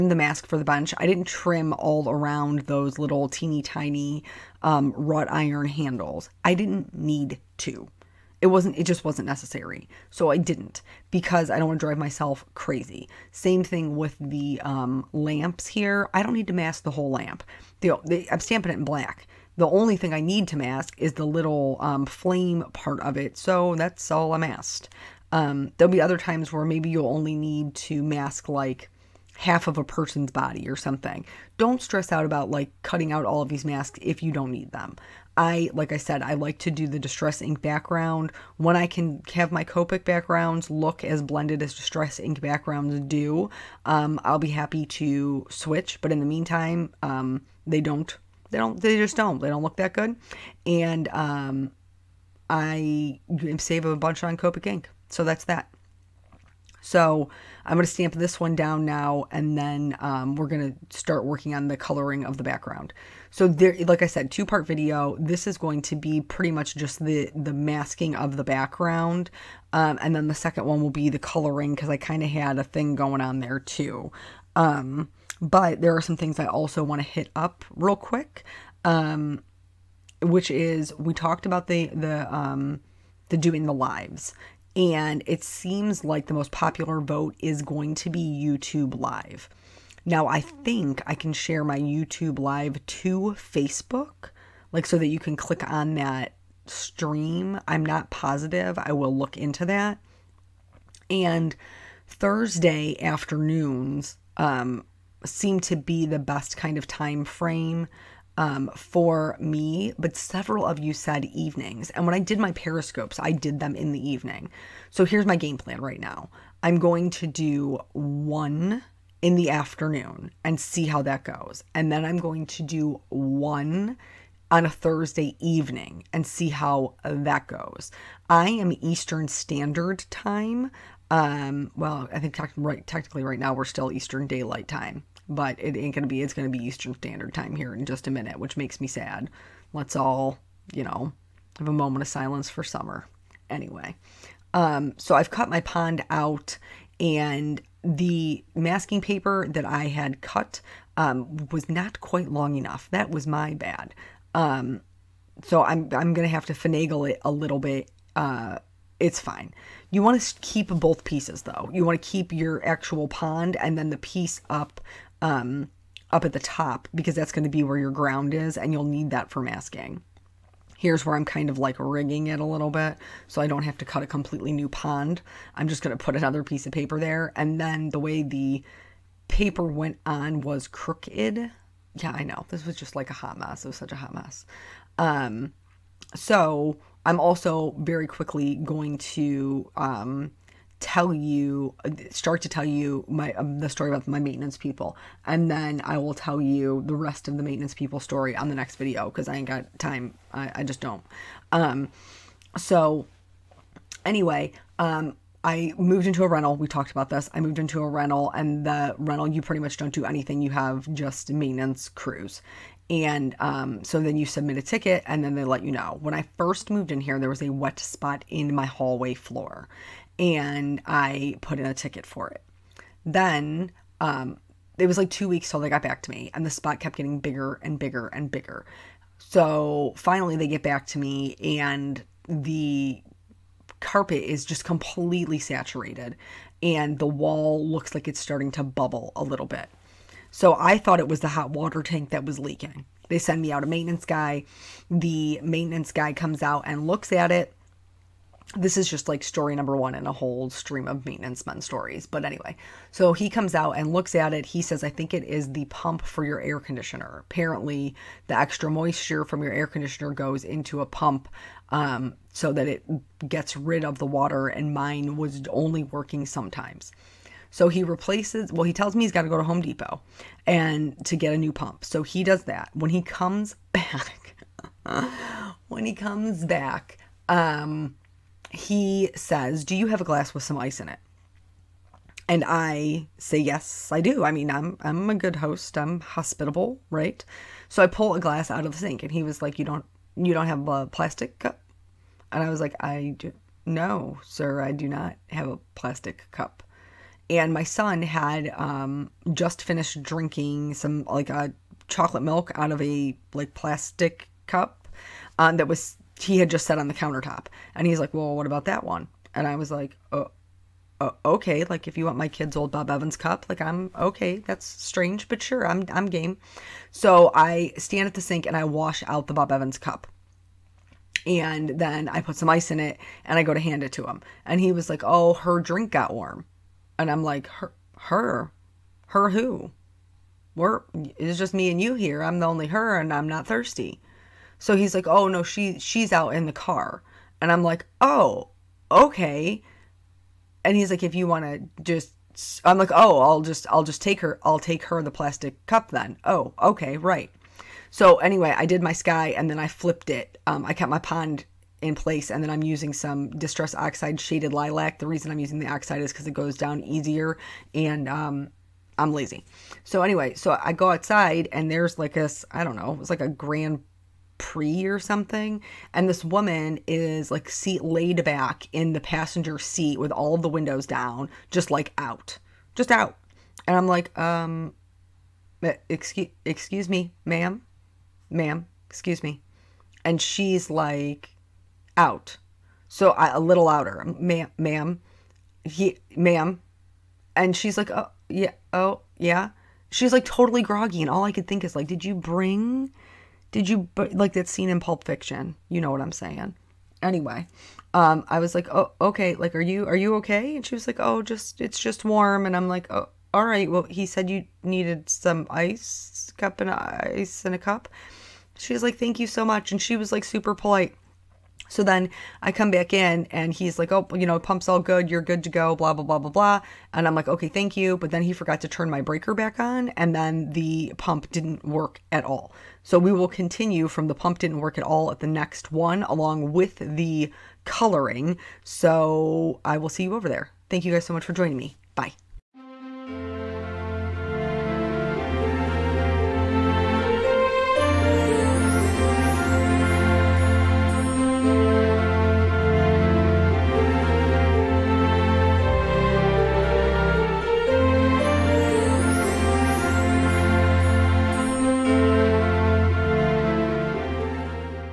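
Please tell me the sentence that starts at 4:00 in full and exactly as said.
So I thought it was the hot water tank that was leaking.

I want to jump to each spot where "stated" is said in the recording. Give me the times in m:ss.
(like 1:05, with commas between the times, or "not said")
not said.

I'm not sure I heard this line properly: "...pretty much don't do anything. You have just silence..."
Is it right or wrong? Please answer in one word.
wrong.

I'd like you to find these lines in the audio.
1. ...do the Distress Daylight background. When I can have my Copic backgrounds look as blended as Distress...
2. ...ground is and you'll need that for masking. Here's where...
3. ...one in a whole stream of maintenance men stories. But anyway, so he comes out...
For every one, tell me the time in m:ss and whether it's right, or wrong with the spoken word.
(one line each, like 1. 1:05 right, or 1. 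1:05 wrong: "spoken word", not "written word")
1. 0:36 wrong: "Ink", not "Daylight"
2. 2:47 right
3. 4:09 right.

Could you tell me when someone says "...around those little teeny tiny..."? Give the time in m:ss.
0:02.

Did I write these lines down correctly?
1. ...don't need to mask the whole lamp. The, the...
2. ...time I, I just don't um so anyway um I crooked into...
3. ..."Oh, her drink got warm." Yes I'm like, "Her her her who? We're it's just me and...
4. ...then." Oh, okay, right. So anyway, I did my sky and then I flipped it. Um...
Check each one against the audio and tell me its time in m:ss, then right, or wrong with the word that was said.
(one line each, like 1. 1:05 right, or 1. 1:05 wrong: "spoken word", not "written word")
1. 0:16 right
2. 3:19 wrong: "moved", not "crooked"
3. 5:25 wrong: "And", not "Yes"
4. 5:45 right.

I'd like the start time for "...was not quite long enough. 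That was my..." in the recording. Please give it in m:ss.
2:31.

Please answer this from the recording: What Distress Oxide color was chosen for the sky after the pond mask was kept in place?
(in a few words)
Shaded Lilac.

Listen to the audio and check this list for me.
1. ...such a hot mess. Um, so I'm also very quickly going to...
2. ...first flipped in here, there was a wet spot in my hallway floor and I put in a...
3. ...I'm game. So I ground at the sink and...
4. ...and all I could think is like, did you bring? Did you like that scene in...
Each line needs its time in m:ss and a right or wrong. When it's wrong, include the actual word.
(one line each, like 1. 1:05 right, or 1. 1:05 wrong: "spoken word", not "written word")
1. 3:03 right
2. 3:36 wrong: "moved", not "flipped"
3. 5:15 wrong: "stand", not "ground"
4. 6:31 right.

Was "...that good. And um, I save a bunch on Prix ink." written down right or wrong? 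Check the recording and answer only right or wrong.
wrong.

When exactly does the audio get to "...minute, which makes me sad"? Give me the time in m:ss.
2:18.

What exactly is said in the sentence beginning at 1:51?
And when I did my periscopes, I did them in the evening.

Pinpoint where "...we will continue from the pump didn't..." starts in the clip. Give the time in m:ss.
7:02.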